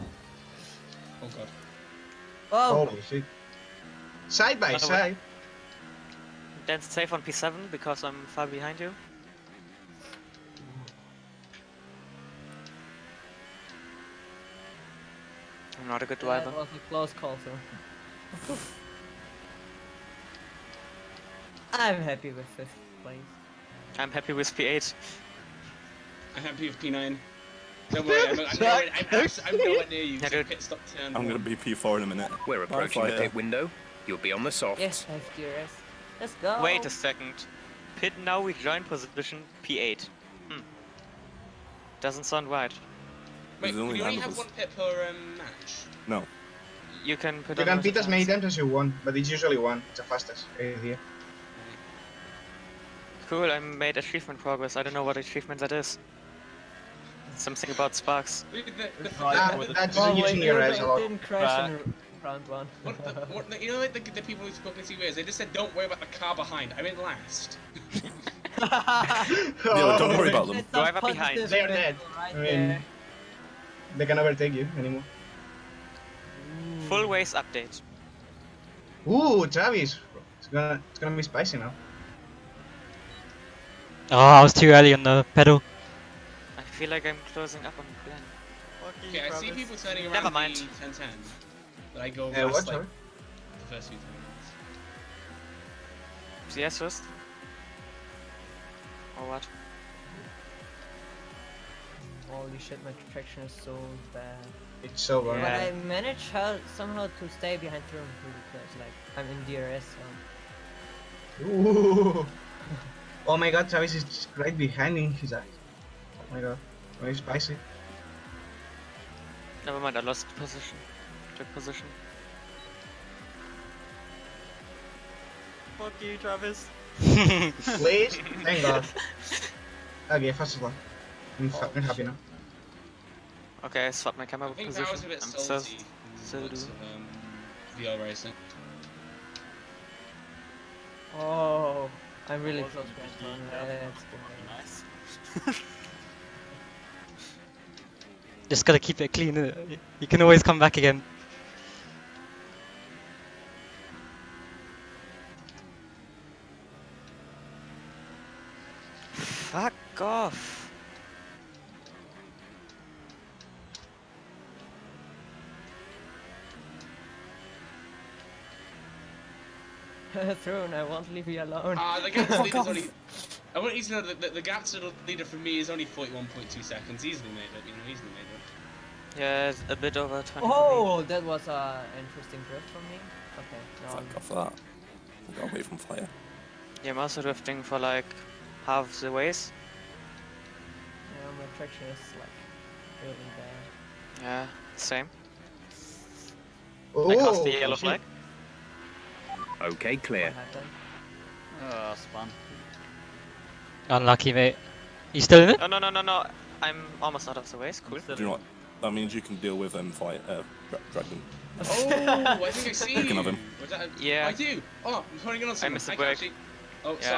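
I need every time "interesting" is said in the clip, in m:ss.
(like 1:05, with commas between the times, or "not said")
3:01.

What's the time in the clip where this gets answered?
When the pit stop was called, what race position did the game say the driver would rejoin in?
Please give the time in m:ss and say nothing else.
0:37.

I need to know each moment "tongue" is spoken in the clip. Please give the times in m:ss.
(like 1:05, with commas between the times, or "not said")
not said.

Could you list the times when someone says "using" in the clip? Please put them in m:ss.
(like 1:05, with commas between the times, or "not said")
1:00.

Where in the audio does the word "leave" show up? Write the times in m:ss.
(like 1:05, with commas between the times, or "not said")
2:51.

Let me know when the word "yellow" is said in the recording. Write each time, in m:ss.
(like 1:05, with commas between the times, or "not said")
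3:17.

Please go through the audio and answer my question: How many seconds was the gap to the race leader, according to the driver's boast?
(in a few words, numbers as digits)
41.2 seconds.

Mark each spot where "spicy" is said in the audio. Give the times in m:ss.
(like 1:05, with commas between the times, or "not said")
1:21, 1:57.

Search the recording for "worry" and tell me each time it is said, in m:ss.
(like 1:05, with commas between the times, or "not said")
0:28, 1:05, 1:10.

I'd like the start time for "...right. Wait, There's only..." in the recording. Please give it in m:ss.
0:42.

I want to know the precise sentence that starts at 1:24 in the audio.
Oh, I was too early on the pedal.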